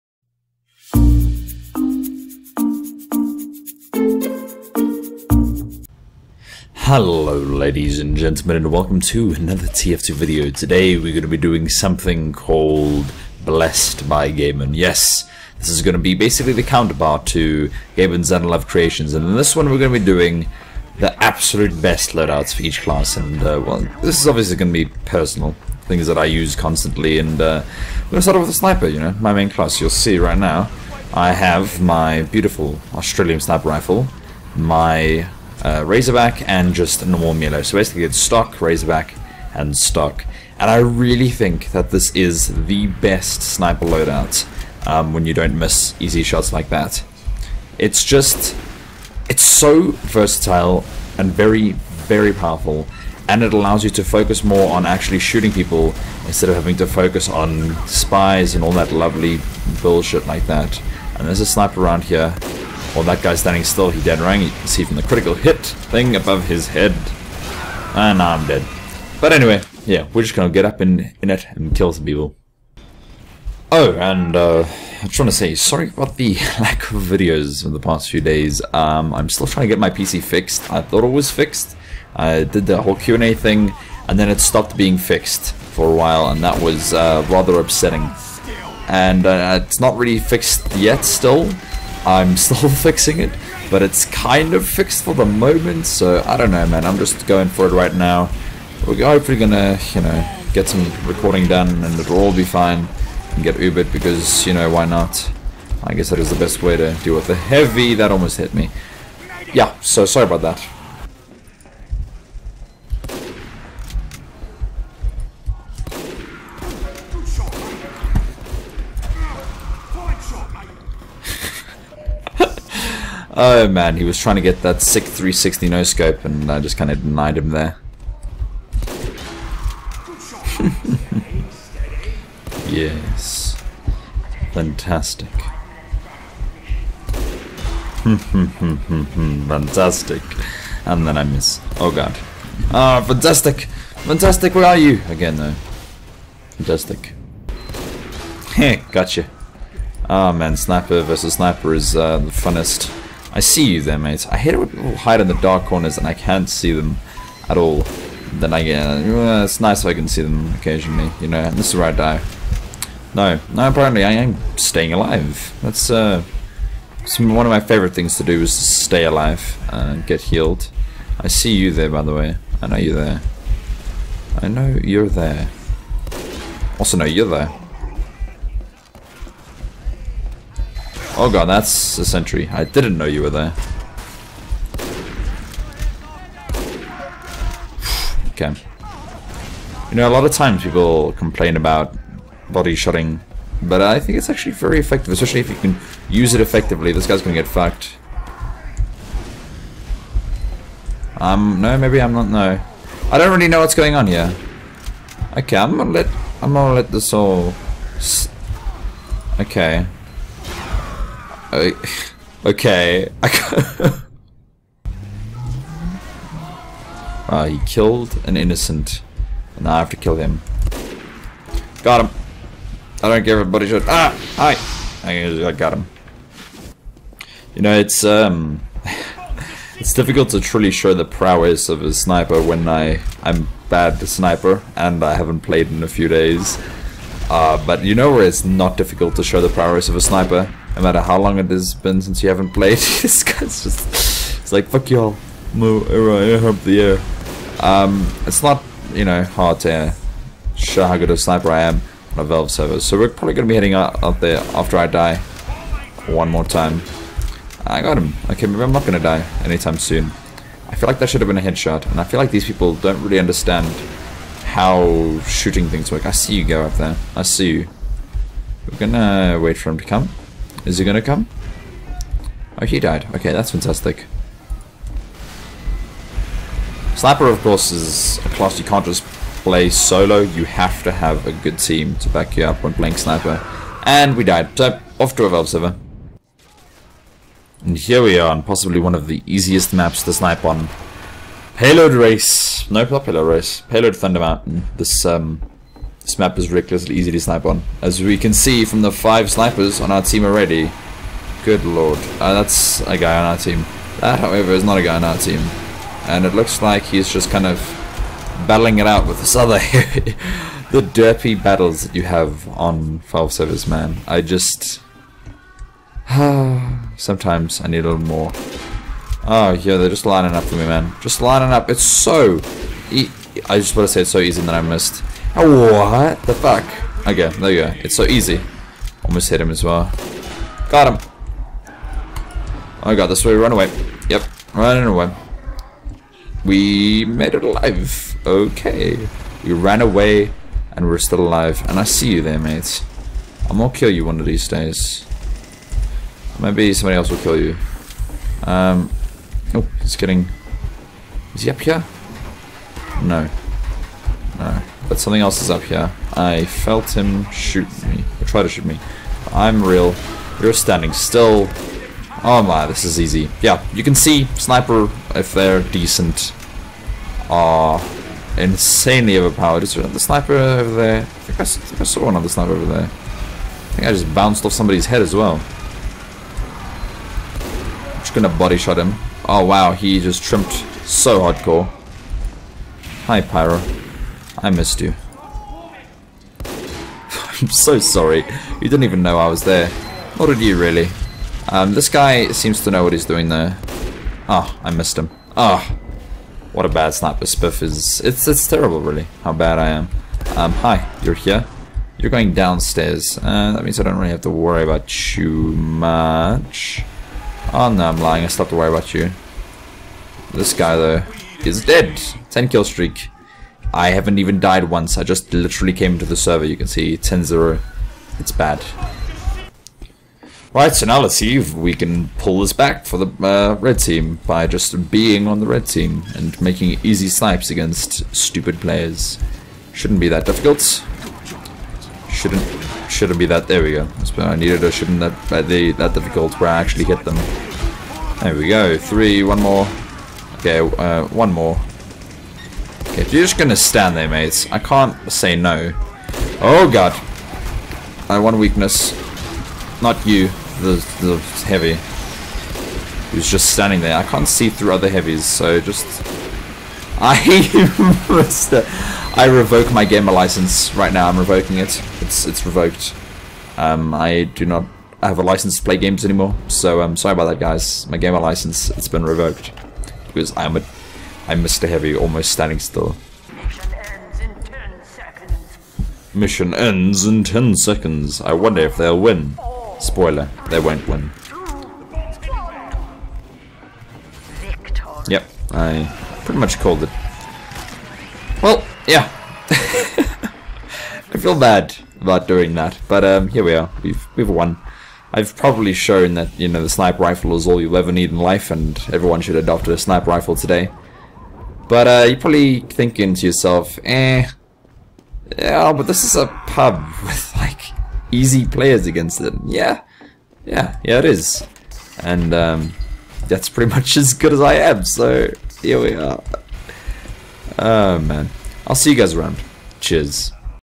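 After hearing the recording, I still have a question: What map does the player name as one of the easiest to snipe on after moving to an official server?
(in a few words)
Thunder Mountain.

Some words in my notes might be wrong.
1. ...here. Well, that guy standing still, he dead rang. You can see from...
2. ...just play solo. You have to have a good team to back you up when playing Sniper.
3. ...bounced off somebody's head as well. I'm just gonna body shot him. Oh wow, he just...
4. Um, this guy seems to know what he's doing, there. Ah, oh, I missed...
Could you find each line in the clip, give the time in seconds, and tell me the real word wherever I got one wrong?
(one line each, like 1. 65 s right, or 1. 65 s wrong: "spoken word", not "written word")
1. 62 s right
2. 278 s right
3. 374 s right
4. 391 s right.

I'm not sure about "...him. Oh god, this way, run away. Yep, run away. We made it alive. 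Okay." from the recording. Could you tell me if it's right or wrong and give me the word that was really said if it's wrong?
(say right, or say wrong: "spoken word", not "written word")
right.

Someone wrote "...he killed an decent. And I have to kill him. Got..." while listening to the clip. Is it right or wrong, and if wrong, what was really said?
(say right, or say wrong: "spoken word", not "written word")
wrong: "innocent", not "decent".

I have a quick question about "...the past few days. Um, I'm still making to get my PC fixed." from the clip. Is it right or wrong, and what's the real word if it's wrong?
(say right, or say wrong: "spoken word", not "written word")
wrong: "trying", not "making".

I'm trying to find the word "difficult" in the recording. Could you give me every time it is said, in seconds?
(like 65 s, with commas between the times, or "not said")
229 s, 238 s, 430 s, 435 s.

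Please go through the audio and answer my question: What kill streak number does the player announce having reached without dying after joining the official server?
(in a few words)
10.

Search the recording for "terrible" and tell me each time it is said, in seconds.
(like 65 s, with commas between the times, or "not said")
398 s.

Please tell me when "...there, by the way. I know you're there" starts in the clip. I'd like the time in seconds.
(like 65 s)
171 s.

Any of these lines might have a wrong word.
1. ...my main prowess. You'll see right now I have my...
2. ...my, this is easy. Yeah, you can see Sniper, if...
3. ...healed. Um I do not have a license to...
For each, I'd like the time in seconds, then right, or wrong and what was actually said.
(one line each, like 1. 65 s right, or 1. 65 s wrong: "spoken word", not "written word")
1. 29 s wrong: "class", not "prowess"
2. 362 s right
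3. 462 s wrong: "revoked", not "healed".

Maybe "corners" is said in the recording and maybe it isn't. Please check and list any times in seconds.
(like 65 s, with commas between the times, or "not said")
155 s.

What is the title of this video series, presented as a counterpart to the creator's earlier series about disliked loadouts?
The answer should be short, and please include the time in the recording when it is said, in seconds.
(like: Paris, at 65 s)
Blessed by GabeN, at 13 s.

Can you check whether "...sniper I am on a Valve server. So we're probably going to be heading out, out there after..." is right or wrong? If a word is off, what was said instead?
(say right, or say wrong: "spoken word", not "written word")
right.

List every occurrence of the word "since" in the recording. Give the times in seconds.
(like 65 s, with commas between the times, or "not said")
242 s.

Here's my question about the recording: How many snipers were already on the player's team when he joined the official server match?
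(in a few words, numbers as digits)
5.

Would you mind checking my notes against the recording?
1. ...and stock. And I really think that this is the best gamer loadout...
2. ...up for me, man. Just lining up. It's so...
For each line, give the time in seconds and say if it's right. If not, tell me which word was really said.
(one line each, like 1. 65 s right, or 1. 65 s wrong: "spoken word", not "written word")
1. 39 s wrong: "sniper", not "gamer"
2. 320 s right.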